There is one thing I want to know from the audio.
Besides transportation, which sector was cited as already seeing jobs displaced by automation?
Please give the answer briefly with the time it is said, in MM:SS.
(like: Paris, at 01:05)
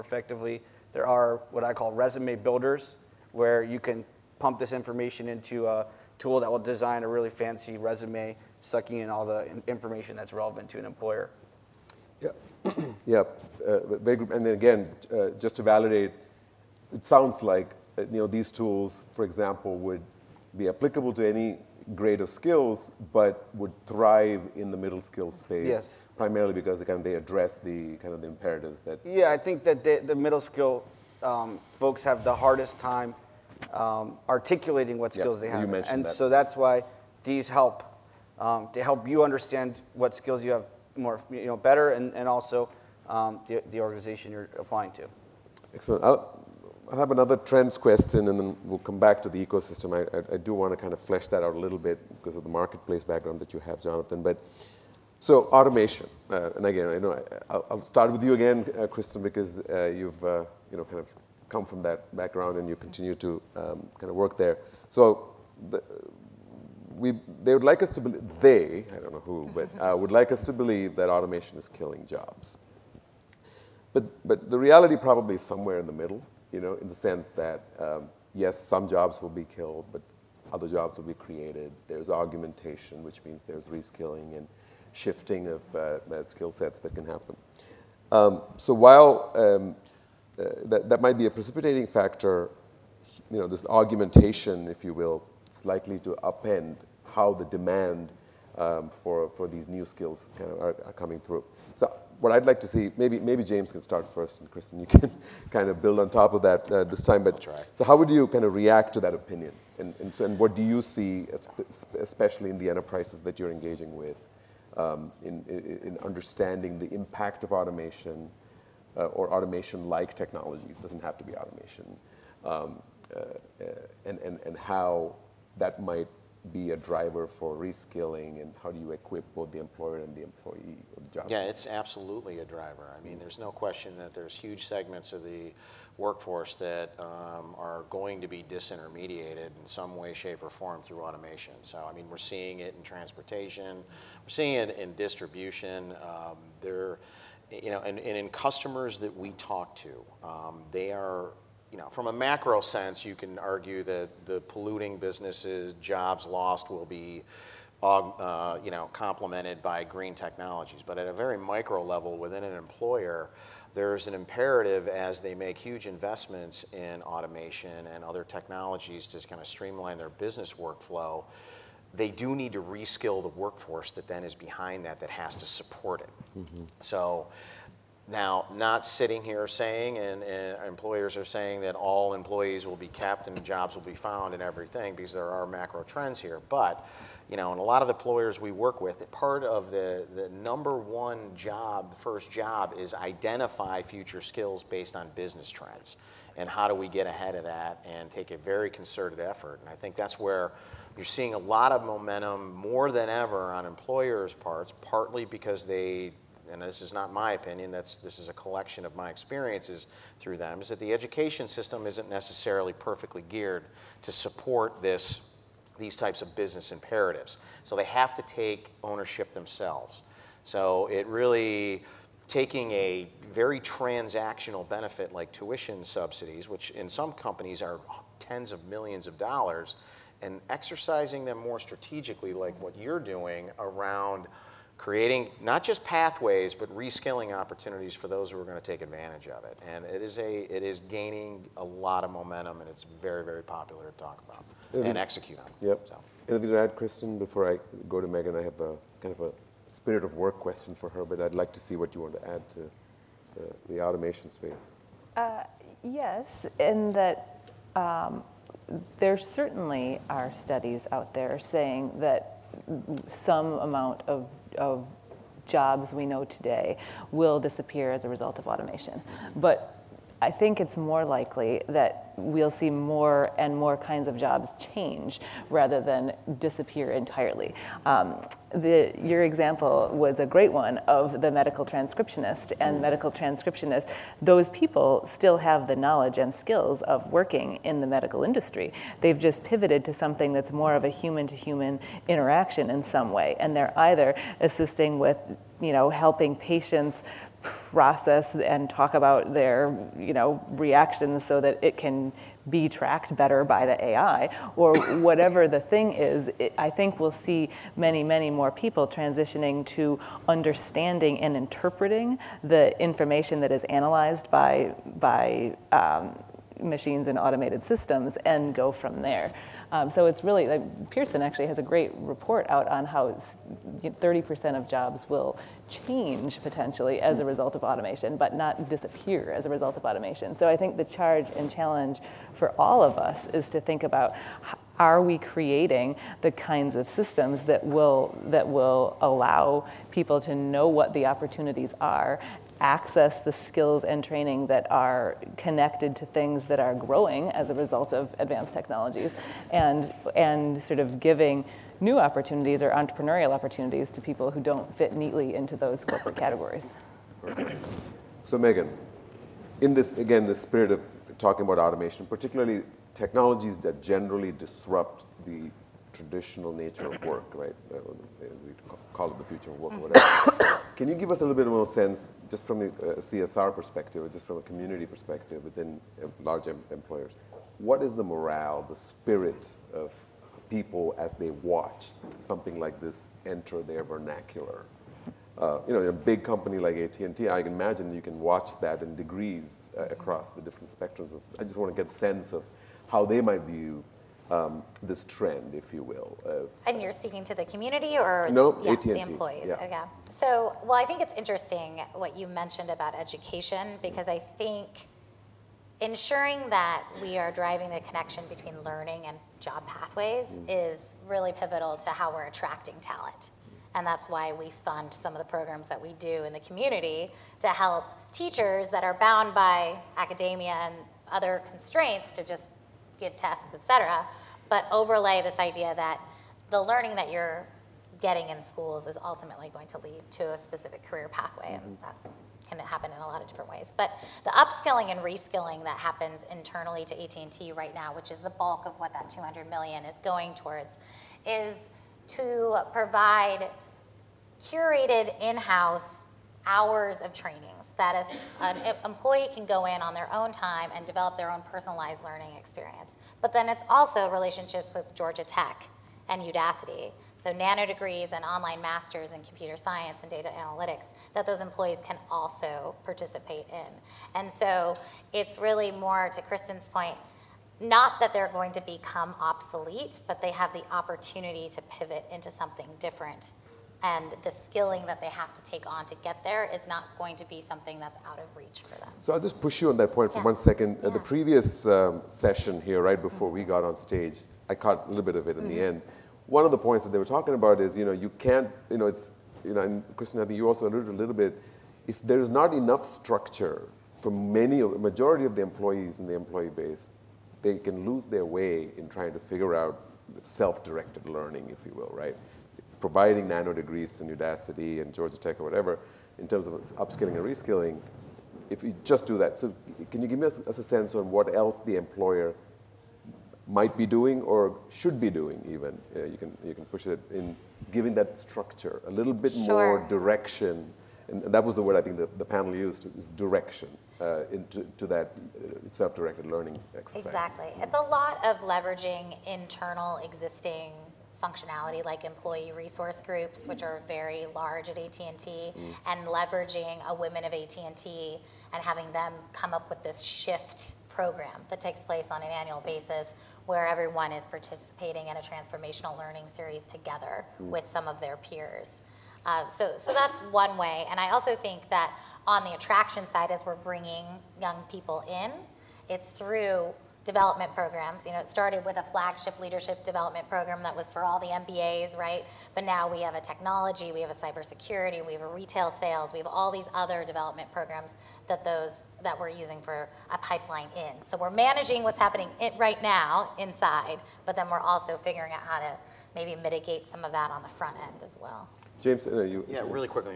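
distribution, at 02:24.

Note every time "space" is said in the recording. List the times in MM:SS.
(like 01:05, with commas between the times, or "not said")
00:25, 04:14.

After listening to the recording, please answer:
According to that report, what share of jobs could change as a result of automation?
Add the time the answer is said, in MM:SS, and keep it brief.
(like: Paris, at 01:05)
30%, at 05:23.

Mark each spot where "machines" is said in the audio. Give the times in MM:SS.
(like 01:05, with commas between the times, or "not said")
05:16.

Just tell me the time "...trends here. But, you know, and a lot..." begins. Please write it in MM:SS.
03:05.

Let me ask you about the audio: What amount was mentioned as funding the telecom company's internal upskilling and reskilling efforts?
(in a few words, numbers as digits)
200 million.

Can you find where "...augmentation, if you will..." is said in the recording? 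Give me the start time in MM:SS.
01:33.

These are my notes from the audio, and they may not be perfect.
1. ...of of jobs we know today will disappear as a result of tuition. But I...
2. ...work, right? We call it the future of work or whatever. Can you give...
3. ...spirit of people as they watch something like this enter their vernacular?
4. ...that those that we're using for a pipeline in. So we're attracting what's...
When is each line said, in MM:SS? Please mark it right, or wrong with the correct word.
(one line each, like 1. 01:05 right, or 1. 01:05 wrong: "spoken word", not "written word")
1. 04:24 wrong: "automation", not "tuition"
2. 06:07 right
3. 06:18 right
4. 09:28 wrong: "managing", not "attracting".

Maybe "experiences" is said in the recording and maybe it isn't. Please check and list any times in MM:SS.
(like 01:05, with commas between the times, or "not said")
03:29, 07:32.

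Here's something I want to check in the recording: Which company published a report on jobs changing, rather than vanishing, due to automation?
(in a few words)
Pearson.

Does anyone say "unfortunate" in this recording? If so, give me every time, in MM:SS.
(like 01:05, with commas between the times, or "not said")
not said.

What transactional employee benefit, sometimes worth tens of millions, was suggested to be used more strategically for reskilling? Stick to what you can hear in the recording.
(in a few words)
tuition subsidies.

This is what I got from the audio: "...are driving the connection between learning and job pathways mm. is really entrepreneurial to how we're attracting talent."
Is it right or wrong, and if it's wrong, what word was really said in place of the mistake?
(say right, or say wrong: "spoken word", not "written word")
wrong: "pivotal", not "entrepreneurial".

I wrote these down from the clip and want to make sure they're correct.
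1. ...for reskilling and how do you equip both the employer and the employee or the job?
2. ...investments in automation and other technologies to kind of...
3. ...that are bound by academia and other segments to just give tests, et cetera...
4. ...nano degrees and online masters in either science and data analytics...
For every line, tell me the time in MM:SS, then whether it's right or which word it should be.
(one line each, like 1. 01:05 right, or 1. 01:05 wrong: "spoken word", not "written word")
1. 02:07 right
2. 02:45 right
3. 06:58 wrong: "constraints", not "segments"
4. 07:37 wrong: "computer", not "either".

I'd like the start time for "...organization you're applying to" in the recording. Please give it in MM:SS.
00:43.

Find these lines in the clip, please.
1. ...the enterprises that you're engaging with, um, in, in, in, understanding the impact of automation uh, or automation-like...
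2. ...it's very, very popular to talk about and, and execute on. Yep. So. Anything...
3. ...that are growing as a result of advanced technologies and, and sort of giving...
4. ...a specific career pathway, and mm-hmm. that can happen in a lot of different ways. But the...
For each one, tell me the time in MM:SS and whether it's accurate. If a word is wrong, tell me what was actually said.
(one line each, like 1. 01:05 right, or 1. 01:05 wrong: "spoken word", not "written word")
1. 01:52 right
2. 04:02 right
3. 05:46 right
4. 07:10 right.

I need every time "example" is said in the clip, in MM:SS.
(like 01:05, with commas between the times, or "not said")
00:19, 04:39.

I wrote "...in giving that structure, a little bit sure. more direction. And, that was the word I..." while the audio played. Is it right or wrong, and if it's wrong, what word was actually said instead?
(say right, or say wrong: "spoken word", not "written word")
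right.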